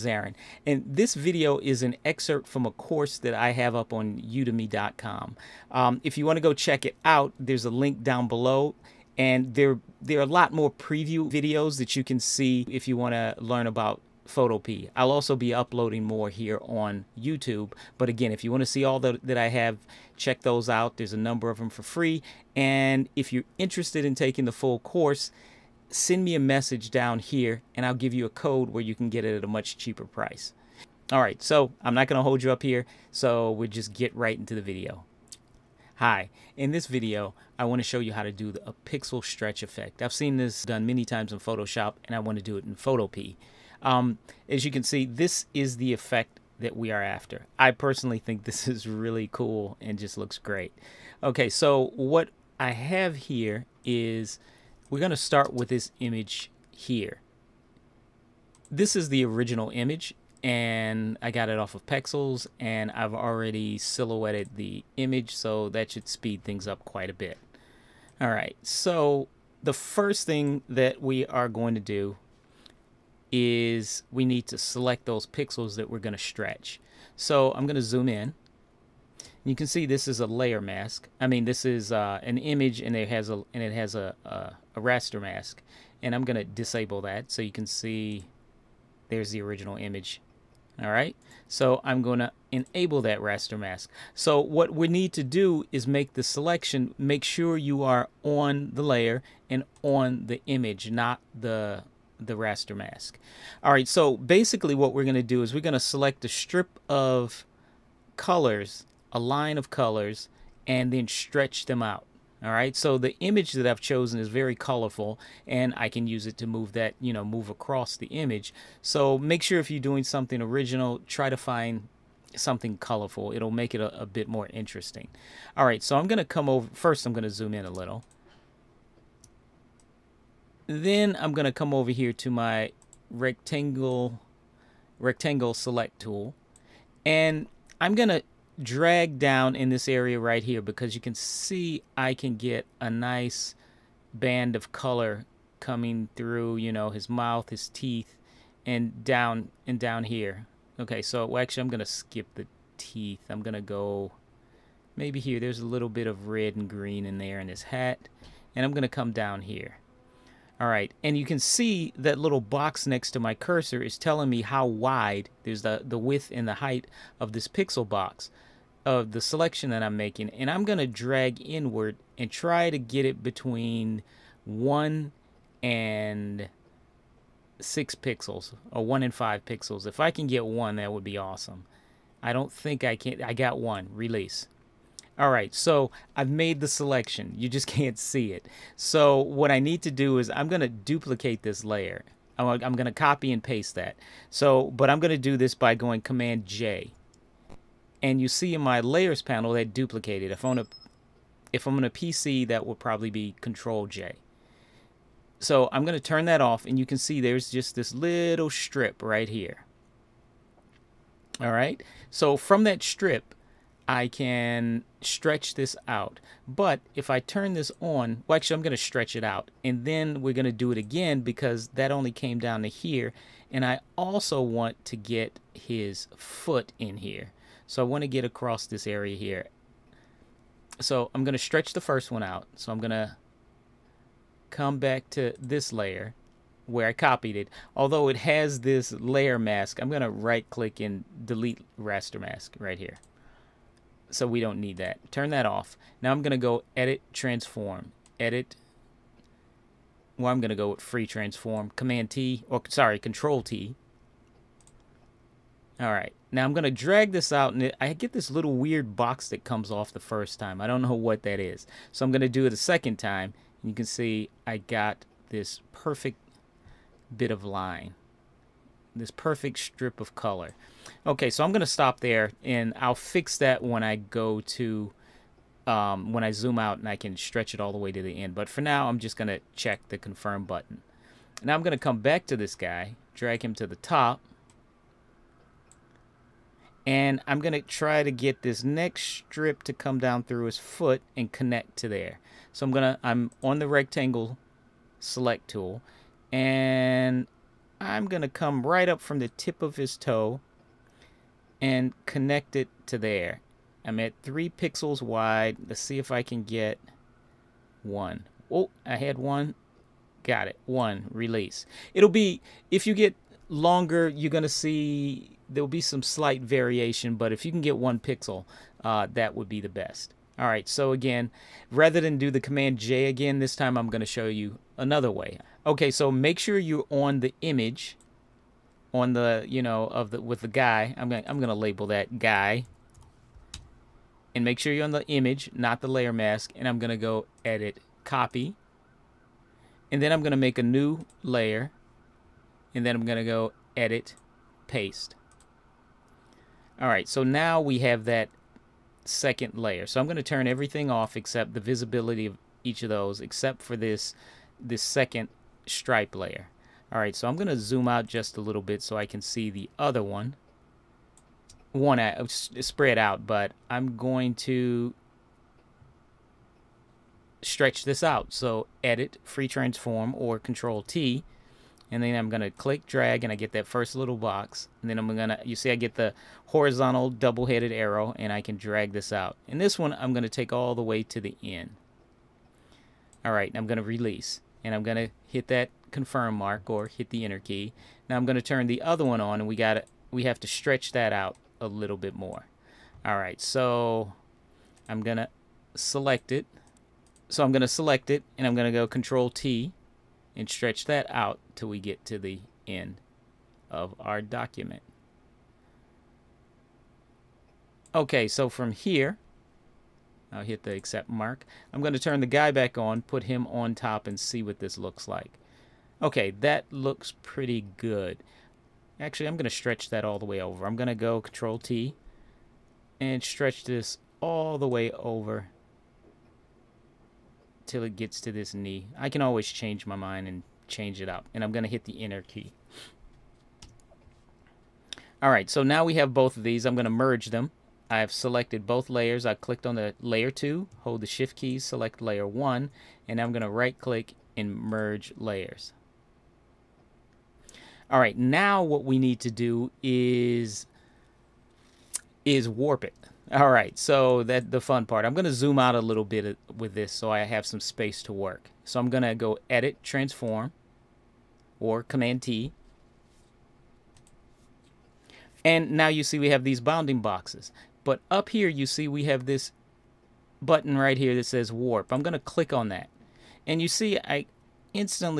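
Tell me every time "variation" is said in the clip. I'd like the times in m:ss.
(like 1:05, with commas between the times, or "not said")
5:16.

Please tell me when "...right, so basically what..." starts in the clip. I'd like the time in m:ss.
1:43.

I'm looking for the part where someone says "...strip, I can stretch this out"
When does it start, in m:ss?
3:32.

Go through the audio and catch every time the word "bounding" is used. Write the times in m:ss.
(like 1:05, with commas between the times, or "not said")
7:46.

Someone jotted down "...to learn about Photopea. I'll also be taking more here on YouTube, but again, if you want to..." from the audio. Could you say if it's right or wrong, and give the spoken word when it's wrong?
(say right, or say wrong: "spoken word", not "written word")
wrong: "uploading", not "taking".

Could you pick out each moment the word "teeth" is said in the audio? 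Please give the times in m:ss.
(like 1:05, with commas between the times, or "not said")
2:27, 2:32.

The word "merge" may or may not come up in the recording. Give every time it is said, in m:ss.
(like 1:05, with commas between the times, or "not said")
7:16, 7:24.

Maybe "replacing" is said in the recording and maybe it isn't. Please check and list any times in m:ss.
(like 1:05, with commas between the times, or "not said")
not said.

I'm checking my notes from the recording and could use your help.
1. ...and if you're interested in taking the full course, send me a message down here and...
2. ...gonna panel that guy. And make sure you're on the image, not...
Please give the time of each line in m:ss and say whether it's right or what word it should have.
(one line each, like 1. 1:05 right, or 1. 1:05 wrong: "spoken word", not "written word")
1. 0:22 right
2. 5:31 wrong: "label", not "panel".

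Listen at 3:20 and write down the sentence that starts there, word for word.
If on a if I'm on a PC, that would probably be Control J.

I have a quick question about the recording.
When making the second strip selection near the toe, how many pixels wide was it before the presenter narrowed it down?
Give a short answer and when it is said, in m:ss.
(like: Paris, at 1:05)
3, at 5:04.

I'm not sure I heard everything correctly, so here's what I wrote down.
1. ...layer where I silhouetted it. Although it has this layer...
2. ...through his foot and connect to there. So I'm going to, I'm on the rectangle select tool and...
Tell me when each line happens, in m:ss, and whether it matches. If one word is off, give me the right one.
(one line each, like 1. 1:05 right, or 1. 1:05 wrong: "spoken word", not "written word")
1. 3:55 wrong: "copied", not "silhouetted"
2. 4:50 right.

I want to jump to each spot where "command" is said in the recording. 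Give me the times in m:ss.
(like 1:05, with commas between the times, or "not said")
3:16, 4:11, 5:22, 7:41.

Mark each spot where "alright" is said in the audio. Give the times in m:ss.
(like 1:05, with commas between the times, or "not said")
6:23, 6:33.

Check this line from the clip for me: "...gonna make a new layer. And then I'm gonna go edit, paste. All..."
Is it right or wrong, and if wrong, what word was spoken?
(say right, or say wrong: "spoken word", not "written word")
right.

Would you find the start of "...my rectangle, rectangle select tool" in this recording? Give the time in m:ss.
2:12.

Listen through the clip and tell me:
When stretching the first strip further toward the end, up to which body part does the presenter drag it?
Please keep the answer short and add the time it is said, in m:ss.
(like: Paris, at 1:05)
knee, at 7:08.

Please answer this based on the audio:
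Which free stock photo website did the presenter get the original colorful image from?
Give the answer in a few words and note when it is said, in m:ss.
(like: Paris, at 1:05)
Pexels, at 1:01.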